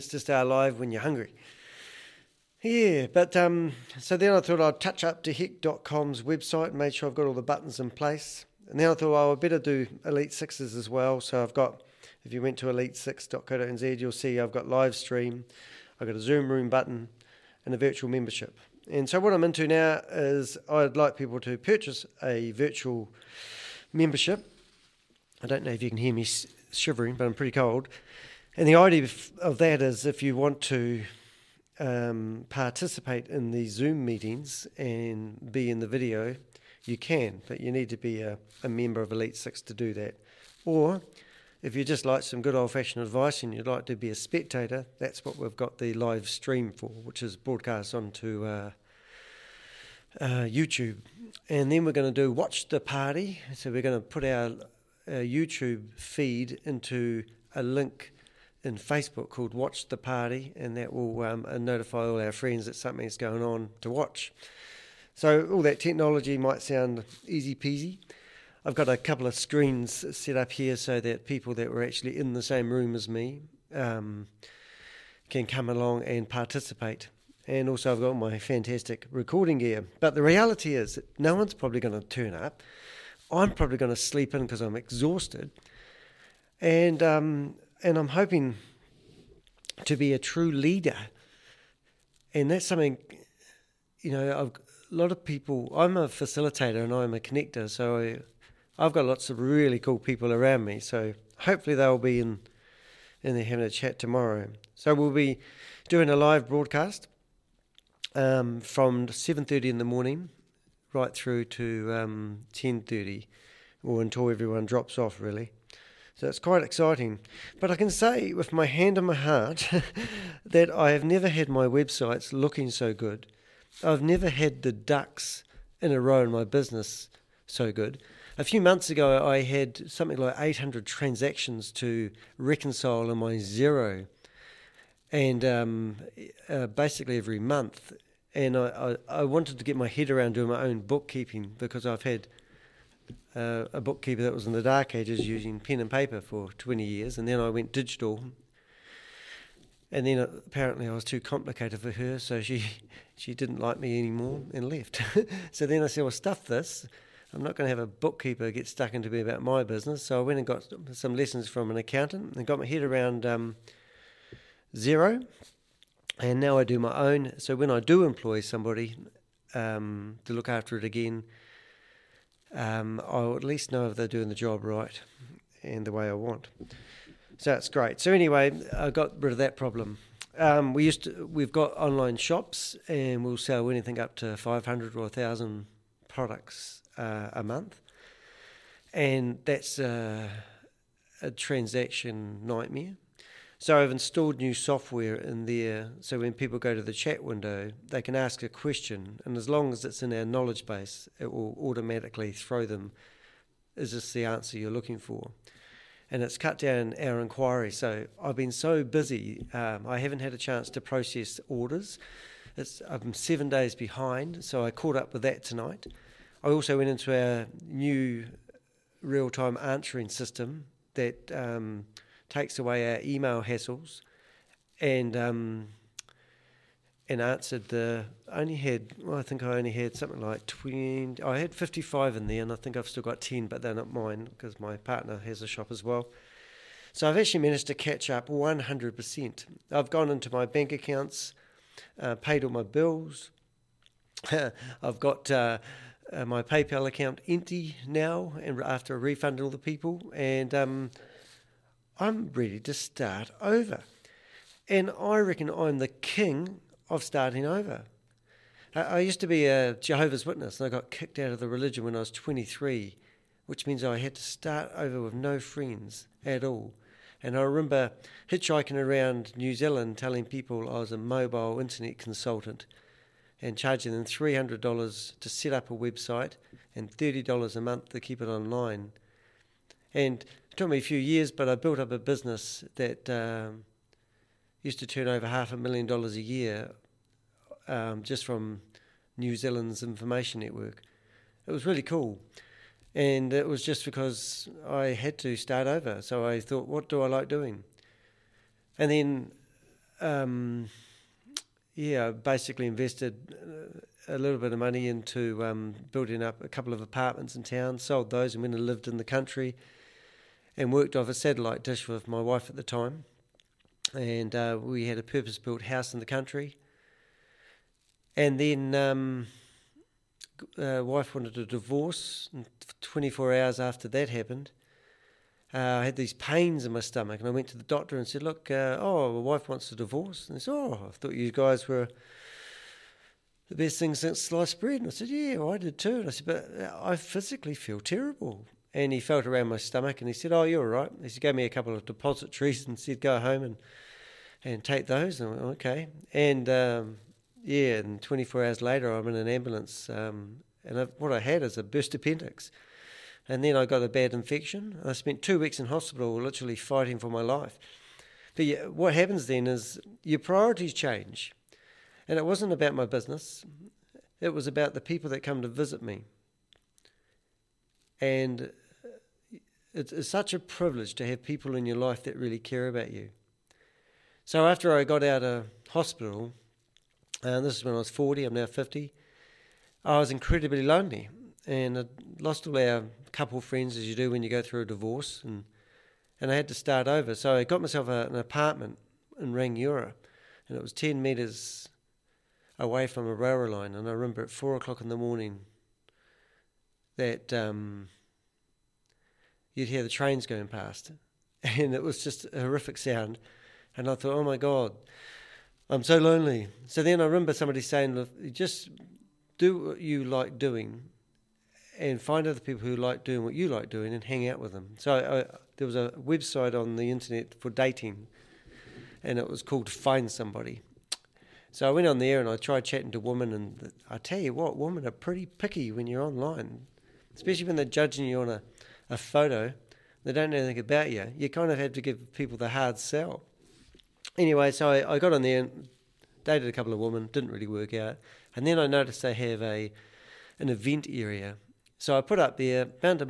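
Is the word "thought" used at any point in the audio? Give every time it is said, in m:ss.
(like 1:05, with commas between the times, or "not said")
0:04, 0:08, 4:56, 5:30, 6:43.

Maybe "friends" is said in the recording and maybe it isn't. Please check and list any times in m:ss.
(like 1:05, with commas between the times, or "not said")
1:02, 4:25, 6:23.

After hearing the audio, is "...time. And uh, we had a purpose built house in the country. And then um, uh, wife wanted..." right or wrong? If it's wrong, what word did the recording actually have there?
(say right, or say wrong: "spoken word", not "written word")
right.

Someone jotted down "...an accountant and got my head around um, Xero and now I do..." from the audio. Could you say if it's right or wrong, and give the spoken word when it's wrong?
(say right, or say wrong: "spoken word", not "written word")
right.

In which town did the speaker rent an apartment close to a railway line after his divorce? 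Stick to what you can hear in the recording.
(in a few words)
Rangiora.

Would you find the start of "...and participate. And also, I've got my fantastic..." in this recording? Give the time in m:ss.
1:16.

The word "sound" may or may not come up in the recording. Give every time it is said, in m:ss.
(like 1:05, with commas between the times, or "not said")
1:06, 6:42.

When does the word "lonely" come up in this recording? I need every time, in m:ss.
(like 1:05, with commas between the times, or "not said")
6:20, 6:45.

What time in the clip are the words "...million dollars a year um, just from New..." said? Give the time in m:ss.
4:45.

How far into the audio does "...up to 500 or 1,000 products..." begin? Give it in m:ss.
3:03.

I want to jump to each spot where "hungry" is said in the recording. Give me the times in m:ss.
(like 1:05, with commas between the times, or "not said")
0:01.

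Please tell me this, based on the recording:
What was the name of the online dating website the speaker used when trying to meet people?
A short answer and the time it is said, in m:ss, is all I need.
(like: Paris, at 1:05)
Find Somebody, at 6:59.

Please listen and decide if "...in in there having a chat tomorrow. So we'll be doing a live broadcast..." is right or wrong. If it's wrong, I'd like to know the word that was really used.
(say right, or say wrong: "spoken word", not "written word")
right.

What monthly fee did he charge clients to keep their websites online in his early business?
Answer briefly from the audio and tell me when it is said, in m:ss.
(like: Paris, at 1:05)
$30, at 4:36.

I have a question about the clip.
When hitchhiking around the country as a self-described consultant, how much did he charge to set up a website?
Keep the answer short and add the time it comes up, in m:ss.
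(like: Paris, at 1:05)
$300, at 4:34.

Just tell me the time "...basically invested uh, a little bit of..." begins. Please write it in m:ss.
5:02.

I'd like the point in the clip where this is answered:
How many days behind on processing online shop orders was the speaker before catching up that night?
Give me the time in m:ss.
3:33.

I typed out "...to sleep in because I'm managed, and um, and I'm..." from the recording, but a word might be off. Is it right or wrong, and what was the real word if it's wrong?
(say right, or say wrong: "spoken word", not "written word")
wrong: "exhausted", not "managed".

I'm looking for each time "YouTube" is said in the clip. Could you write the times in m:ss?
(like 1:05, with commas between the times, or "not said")
0:50, 0:55.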